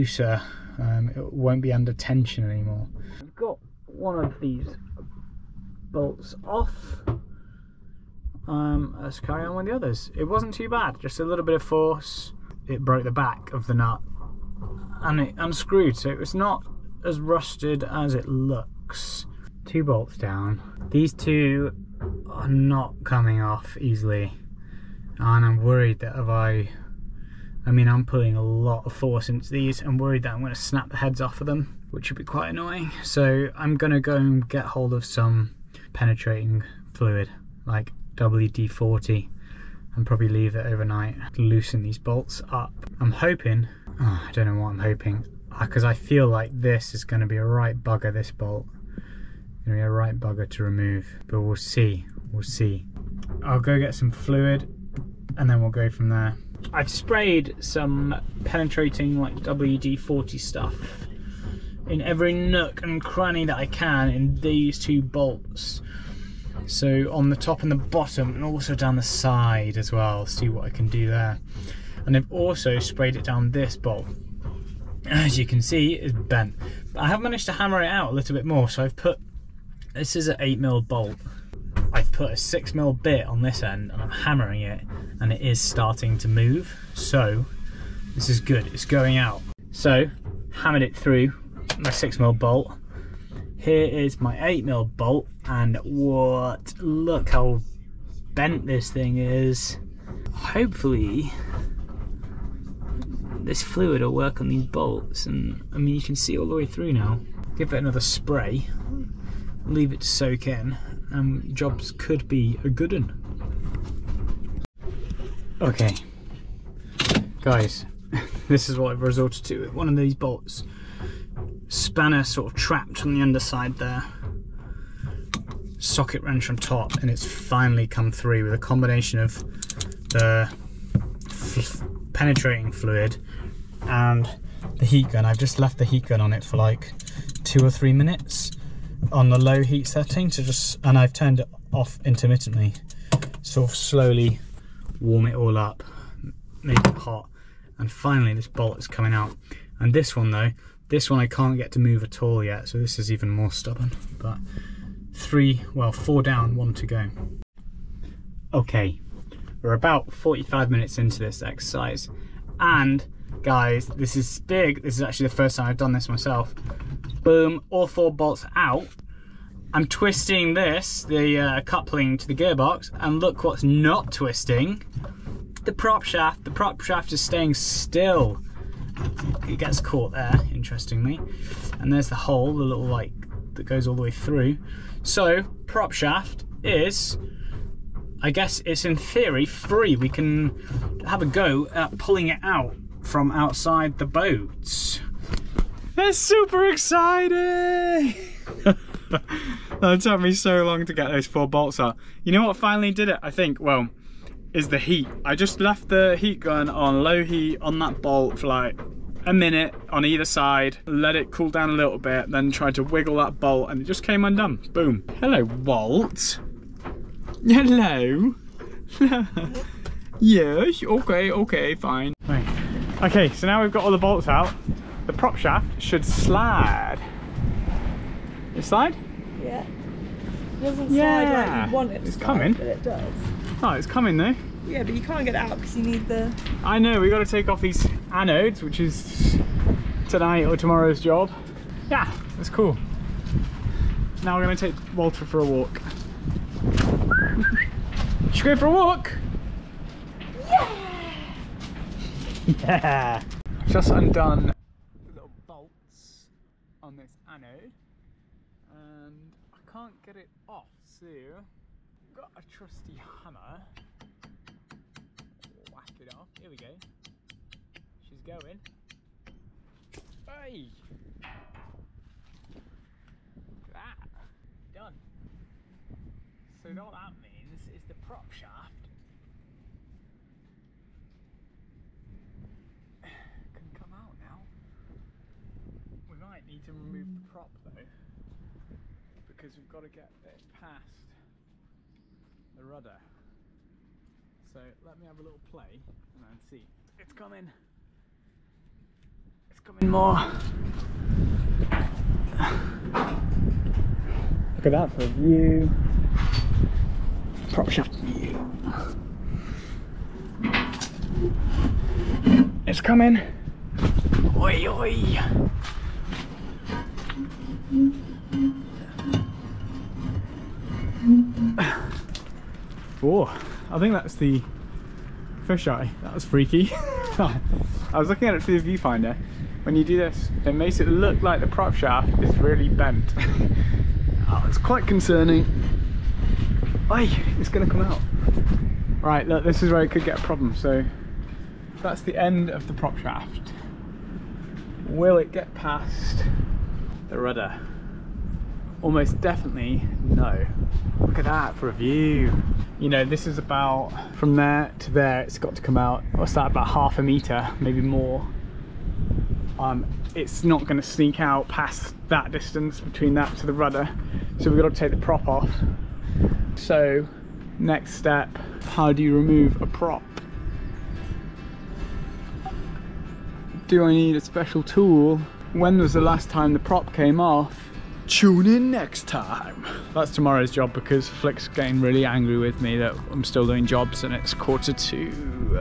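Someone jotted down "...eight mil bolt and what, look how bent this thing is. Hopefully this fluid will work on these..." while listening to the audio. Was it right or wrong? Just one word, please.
right.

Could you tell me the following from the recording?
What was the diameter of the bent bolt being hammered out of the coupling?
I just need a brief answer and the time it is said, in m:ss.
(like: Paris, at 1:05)
8mm, at 1:20.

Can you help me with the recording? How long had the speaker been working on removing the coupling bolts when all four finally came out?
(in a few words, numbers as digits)
45 minutes.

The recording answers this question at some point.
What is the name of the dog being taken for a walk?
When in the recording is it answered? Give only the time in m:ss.
4:04.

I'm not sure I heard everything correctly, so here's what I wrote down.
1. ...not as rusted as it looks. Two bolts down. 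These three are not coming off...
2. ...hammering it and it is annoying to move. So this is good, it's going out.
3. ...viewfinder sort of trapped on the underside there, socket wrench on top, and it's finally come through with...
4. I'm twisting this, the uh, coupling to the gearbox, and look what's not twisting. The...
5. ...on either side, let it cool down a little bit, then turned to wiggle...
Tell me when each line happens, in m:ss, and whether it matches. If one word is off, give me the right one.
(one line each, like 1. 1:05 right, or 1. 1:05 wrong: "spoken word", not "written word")
1. 0:16 wrong: "two", not "three"
2. 1:24 wrong: "starting", not "annoying"
3. 2:01 wrong: "spanner", not "viewfinder"
4. 2:49 right
5. 3:29 wrong: "tried", not "turned".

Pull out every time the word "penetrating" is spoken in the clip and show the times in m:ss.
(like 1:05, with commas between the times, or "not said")
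0:35, 0:58, 2:12.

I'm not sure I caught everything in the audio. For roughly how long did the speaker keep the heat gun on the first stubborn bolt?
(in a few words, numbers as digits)
two or three minutes.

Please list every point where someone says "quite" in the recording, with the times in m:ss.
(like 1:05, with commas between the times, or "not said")
0:32, 5:34.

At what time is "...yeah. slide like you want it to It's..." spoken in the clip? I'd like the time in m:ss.
3:50.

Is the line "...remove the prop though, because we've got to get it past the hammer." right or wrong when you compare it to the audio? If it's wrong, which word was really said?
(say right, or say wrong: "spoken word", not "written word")
wrong: "rudder", not "hammer".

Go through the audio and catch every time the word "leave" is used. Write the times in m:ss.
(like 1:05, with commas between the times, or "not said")
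0:40, 1:49.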